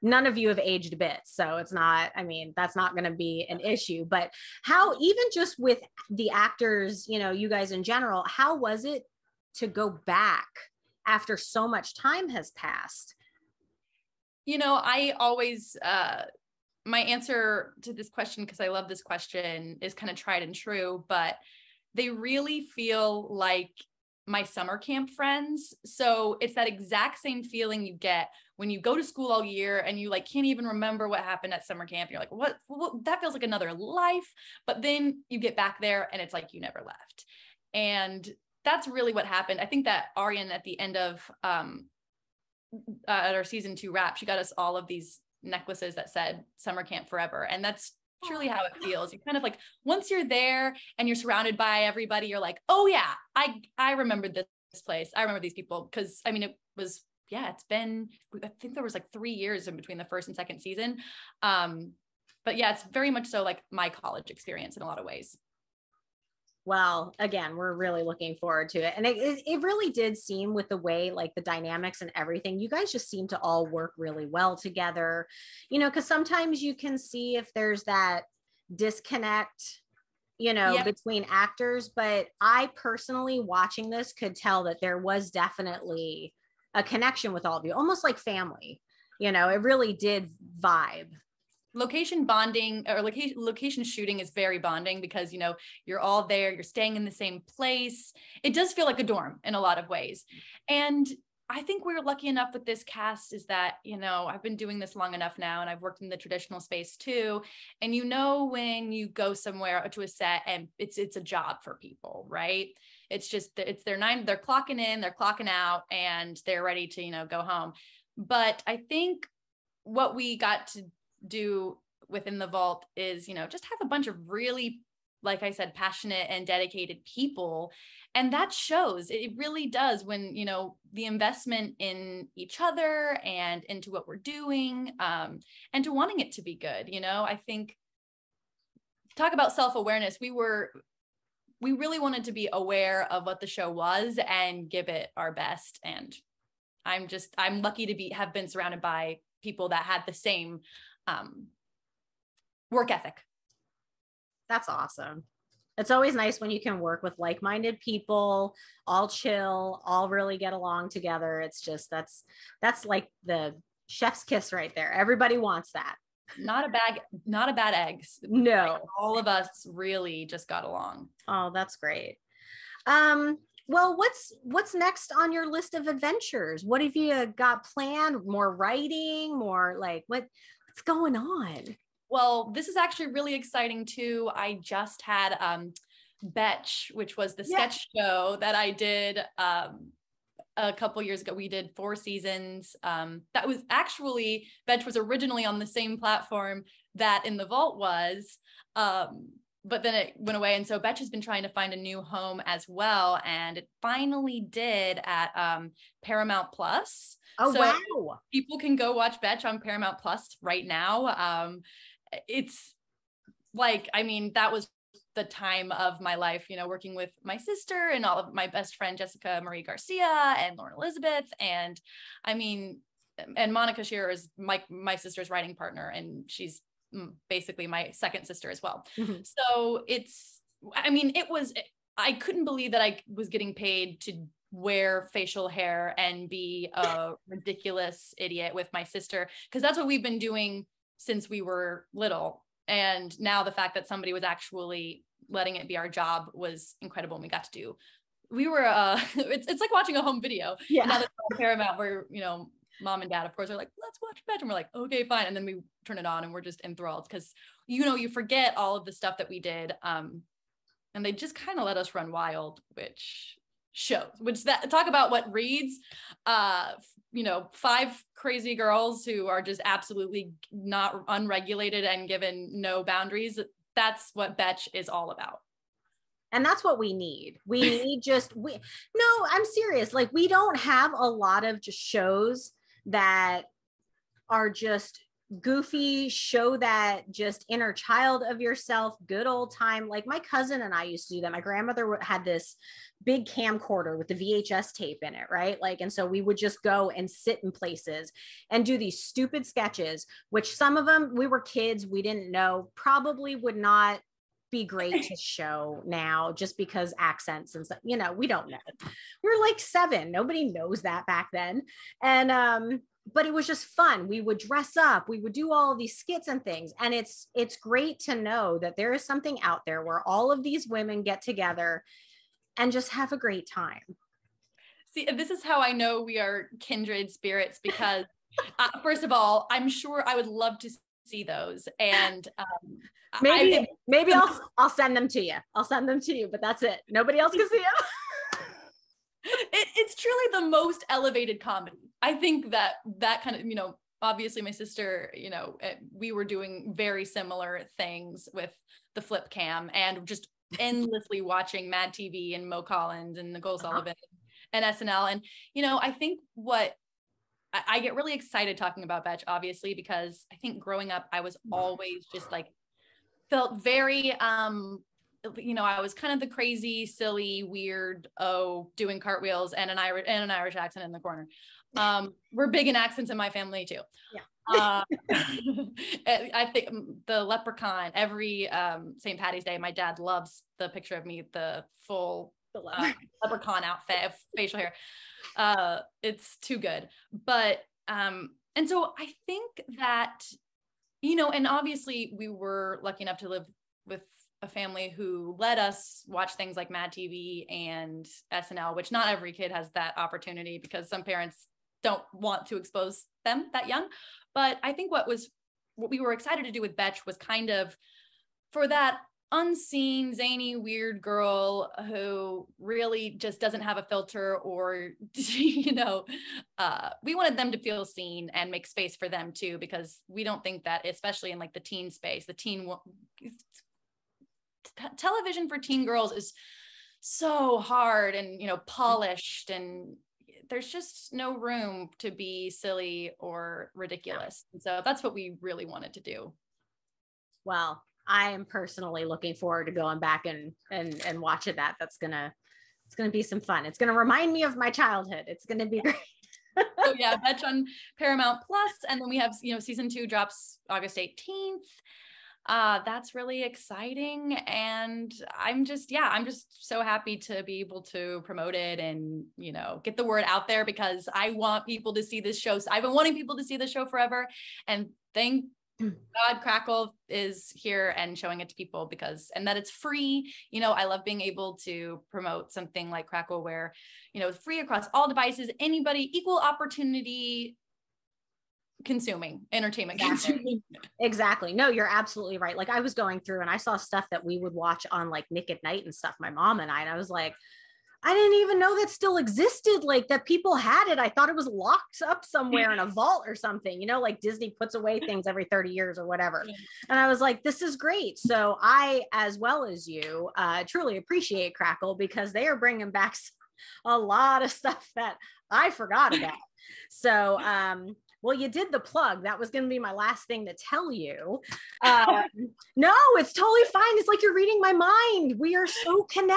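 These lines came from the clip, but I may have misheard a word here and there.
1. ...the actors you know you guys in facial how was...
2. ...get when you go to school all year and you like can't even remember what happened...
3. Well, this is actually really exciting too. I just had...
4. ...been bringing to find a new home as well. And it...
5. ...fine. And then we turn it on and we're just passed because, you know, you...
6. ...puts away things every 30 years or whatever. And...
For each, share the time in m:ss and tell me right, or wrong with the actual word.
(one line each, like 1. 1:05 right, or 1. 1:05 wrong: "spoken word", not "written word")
1. 0:06 wrong: "general", not "facial"
2. 0:27 right
3. 3:02 right
4. 3:21 wrong: "trying", not "bringing"
5. 4:15 wrong: "enthralled", not "passed"
6. 8:14 right.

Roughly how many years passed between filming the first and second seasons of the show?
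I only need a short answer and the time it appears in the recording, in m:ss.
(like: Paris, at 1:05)
3, at 0:59.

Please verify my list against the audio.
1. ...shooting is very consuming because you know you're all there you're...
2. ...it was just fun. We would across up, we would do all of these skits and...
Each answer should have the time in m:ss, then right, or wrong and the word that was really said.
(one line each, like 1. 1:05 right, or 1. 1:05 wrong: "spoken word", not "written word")
1. 1:33 wrong: "bonding", not "consuming"
2. 5:13 wrong: "dress", not "across".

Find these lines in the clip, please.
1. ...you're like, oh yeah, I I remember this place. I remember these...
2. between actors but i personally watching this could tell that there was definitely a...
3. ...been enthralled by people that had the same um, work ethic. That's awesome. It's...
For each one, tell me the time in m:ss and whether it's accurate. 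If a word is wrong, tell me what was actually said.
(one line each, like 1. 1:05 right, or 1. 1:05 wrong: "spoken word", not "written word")
1. 0:52 right
2. 1:20 right
3. 2:28 wrong: "surrounded", not "enthralled".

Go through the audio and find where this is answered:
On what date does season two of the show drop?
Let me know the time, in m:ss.
7:30.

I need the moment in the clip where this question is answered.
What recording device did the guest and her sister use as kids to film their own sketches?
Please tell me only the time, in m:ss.
5:49.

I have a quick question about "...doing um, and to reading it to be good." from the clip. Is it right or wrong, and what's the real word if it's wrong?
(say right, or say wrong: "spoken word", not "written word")
wrong: "wanting", not "reading".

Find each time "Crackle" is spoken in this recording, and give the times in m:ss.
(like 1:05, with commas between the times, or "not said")
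7:46, 7:53, 8:21.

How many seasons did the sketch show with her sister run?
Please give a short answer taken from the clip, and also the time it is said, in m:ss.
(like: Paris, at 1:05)
4, at 3:11.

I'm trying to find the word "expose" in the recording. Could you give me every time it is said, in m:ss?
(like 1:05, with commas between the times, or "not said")
6:42.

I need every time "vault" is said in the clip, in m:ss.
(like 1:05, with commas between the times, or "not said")
2:02, 3:17, 8:12.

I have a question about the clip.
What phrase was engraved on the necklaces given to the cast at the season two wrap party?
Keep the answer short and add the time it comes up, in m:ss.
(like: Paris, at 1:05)
Summer camp forever, at 0:46.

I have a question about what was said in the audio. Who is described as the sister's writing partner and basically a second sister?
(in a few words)
Monica Sherer.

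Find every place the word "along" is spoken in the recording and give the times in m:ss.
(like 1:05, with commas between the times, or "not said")
2:40, 2:50.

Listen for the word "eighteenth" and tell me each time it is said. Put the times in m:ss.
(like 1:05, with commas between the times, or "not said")
7:30.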